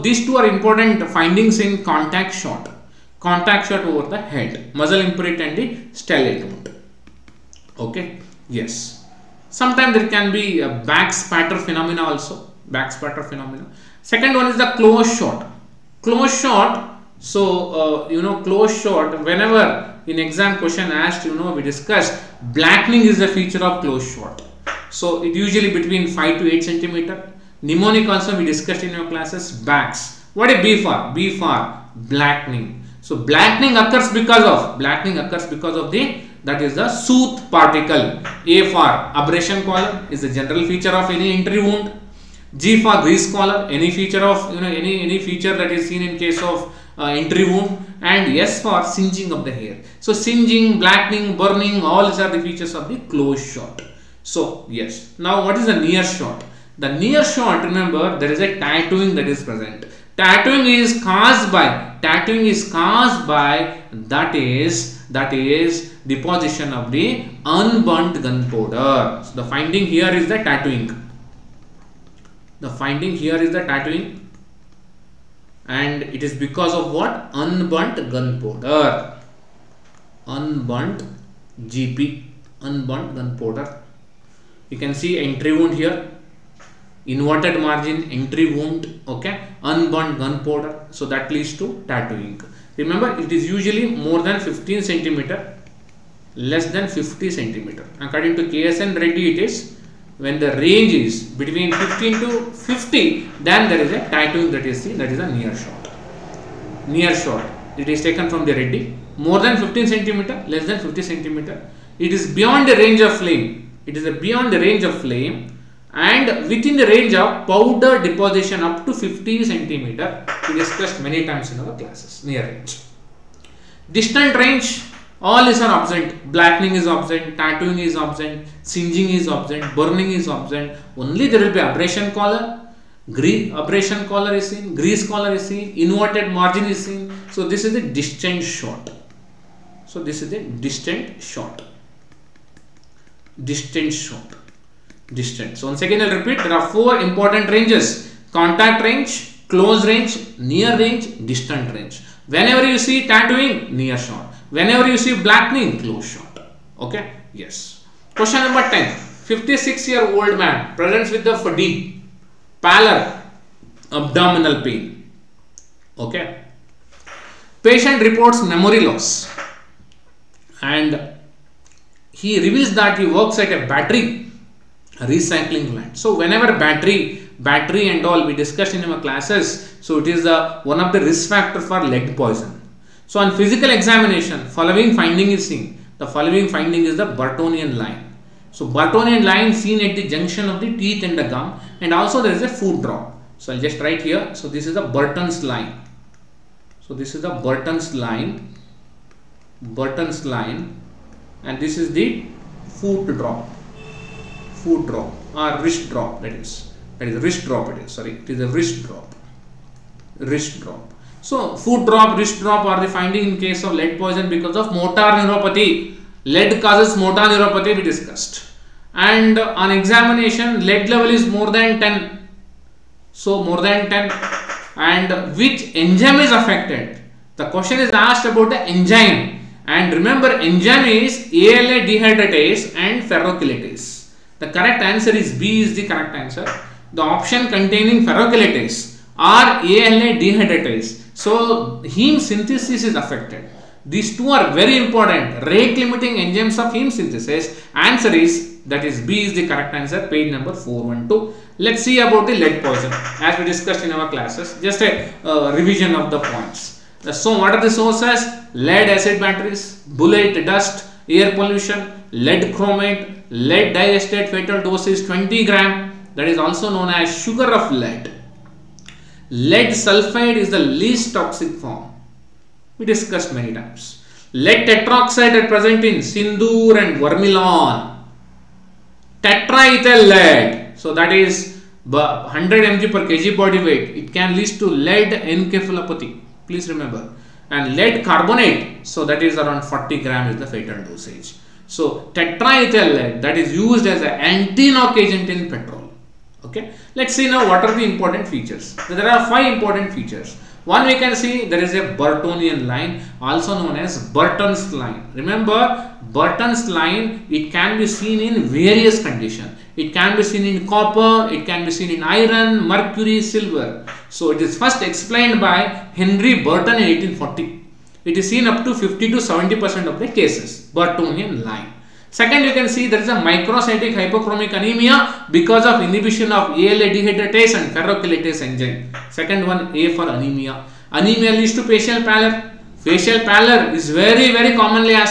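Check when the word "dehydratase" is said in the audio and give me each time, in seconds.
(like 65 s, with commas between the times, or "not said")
231 s, 240 s, 326 s.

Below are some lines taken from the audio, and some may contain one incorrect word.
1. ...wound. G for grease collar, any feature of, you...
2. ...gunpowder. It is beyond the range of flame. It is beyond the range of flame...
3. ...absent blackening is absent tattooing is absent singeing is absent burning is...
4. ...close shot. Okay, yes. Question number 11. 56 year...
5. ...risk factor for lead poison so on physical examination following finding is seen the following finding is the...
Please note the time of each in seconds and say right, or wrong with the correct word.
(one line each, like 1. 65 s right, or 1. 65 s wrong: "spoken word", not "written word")
1. 41 s right
2. 111 s wrong: "centimeter", not "gunpowder"
3. 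125 s right
4. 155 s wrong: "10", not "11"
5. 181 s right.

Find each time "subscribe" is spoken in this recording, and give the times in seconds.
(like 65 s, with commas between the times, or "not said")
not said.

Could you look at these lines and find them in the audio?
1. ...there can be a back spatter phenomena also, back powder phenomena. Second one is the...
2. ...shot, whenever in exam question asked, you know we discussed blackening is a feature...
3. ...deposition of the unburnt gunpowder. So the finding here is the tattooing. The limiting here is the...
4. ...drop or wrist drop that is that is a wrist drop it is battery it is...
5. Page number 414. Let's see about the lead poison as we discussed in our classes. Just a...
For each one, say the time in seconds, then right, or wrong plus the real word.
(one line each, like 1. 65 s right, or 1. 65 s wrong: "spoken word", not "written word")
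1. 9 s wrong: "spatter", not "powder"
2. 18 s right
3. 66 s wrong: "finding", not "limiting"
4. 204 s wrong: "sorry", not "battery"
5. 250 s wrong: "412", not "414".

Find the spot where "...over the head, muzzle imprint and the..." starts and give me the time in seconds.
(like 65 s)
3 s.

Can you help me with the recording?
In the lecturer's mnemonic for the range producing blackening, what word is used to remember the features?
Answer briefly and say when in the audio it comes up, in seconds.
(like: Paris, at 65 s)
Backs, at 29 s.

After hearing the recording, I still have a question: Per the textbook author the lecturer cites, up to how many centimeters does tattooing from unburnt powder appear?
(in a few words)
50.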